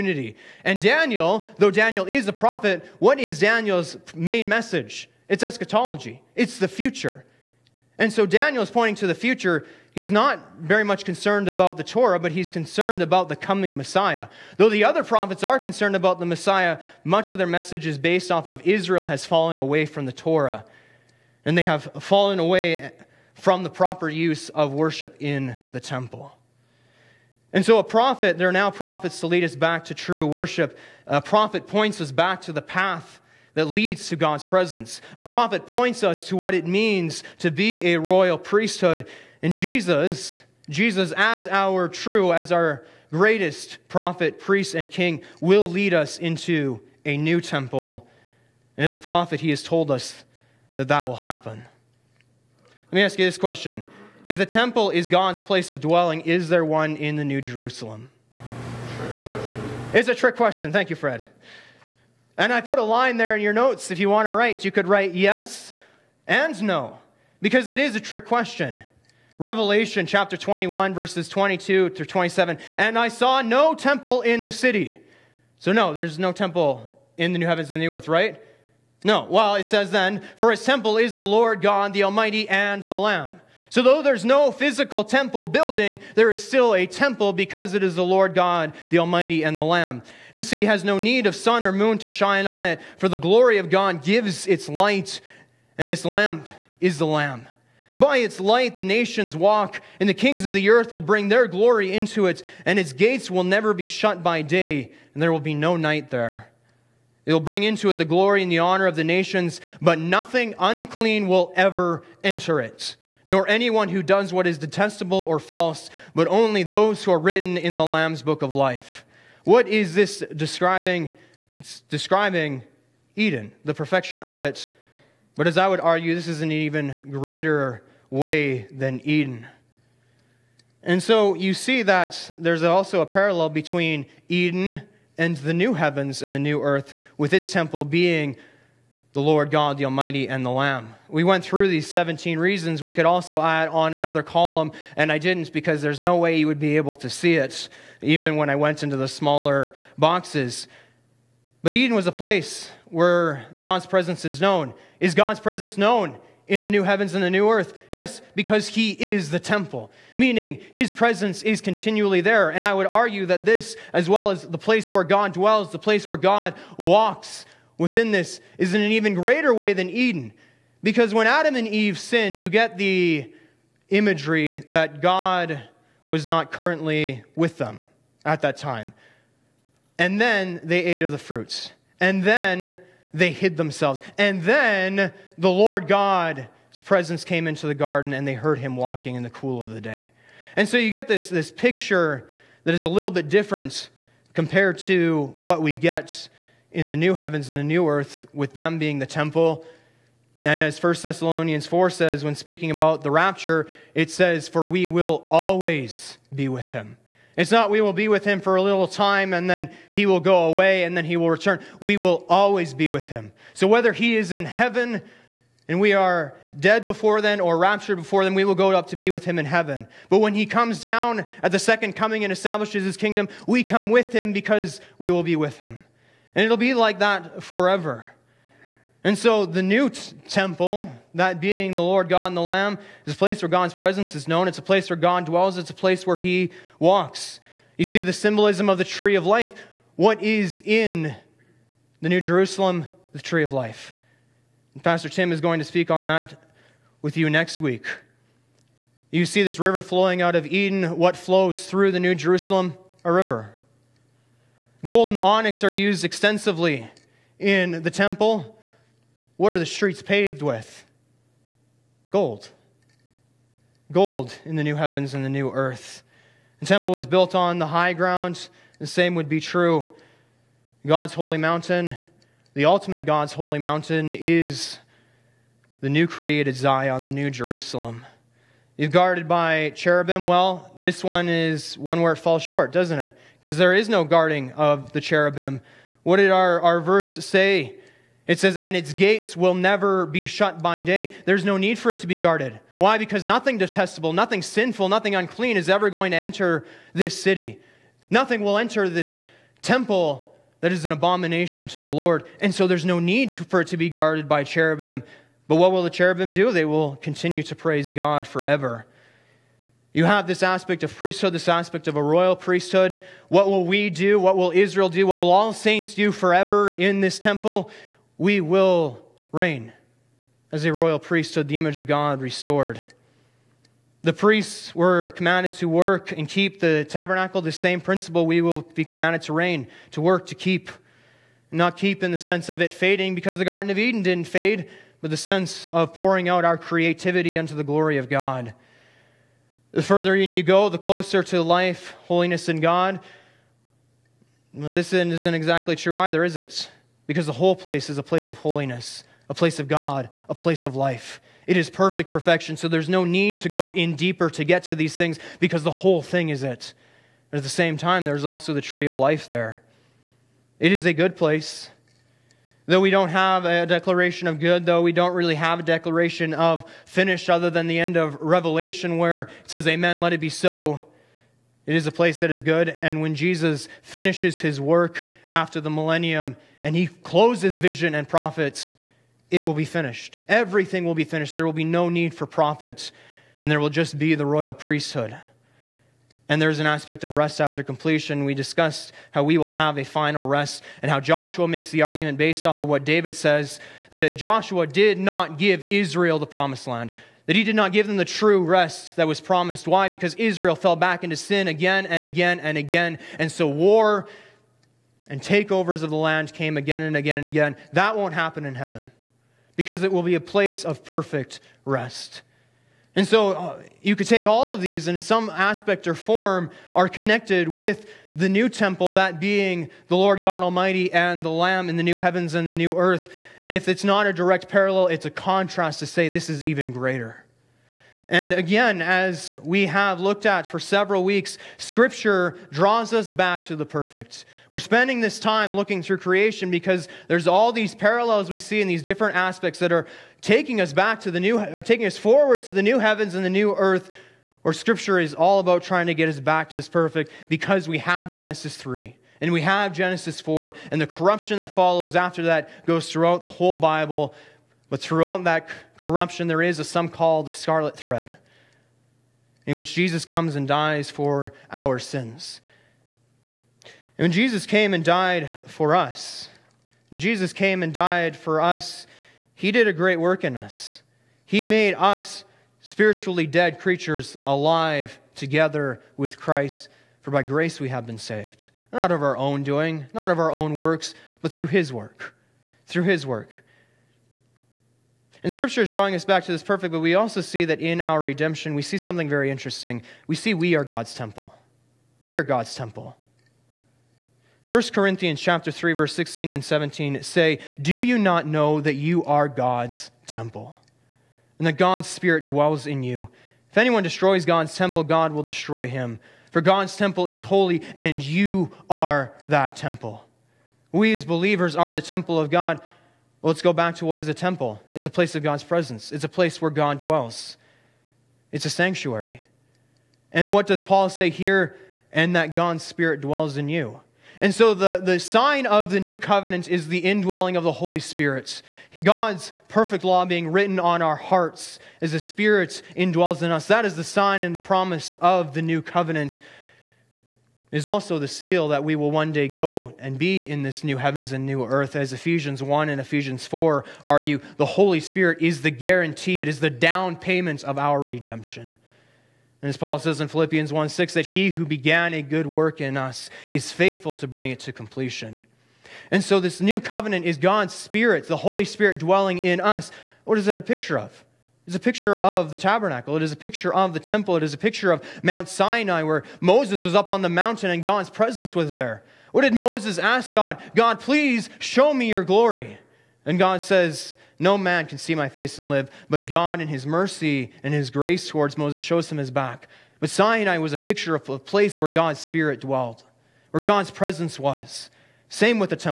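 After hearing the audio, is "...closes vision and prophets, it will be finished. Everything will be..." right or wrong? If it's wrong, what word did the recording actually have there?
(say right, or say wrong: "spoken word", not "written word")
right.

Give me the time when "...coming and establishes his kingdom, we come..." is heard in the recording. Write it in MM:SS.
03:41.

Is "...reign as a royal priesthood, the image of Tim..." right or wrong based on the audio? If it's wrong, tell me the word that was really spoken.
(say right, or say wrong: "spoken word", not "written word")
wrong: "God", not "Tim".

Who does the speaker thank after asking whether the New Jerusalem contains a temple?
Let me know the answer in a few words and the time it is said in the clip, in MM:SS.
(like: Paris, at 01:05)
Fred, at 01:00.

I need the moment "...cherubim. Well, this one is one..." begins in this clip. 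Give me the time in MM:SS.
04:39.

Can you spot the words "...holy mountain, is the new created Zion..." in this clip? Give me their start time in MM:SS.
04:33.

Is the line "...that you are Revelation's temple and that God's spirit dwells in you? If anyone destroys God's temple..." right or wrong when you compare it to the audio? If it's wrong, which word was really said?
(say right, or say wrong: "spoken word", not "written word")
wrong: "God", not "Revelation".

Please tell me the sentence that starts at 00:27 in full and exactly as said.
And so, a prophet, there are now prophets to lead us back to true worship.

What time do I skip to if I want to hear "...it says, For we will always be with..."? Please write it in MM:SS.
03:23.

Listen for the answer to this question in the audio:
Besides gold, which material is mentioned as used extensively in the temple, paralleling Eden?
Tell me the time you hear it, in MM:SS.
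04:15.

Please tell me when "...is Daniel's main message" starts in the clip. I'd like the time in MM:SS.
00:03.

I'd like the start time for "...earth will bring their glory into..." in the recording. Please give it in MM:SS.
01:40.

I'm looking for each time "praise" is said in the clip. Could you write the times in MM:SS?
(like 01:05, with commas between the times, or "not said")
05:07.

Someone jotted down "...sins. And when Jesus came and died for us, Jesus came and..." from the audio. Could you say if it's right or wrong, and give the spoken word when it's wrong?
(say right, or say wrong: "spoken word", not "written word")
right.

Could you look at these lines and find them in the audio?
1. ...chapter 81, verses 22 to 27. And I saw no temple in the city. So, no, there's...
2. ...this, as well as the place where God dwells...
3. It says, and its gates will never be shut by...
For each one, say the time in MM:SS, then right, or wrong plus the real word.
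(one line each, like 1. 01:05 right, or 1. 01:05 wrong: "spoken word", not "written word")
1. 01:10 wrong: "21", not "81"
2. 02:43 right
3. 04:48 right.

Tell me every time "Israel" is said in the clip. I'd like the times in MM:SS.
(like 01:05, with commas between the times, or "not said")
00:18, 05:14, 06:35, 06:40.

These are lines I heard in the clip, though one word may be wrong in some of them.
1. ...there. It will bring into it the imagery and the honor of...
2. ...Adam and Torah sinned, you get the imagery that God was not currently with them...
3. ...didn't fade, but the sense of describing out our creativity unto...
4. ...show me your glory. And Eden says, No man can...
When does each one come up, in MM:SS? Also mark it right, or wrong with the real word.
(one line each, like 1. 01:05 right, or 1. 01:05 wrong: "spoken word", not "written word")
1. 01:46 wrong: "glory", not "imagery"
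2. 02:51 wrong: "Eve", not "Torah"
3. 05:34 wrong: "pouring", not "describing"
4. 09:31 wrong: "God", not "Eden".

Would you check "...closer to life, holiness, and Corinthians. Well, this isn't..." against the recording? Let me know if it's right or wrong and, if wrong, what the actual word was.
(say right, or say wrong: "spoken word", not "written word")
wrong: "God", not "Corinthians".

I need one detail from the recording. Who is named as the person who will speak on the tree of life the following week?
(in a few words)
Pastor Tim.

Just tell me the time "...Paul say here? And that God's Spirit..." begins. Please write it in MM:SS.
08:40.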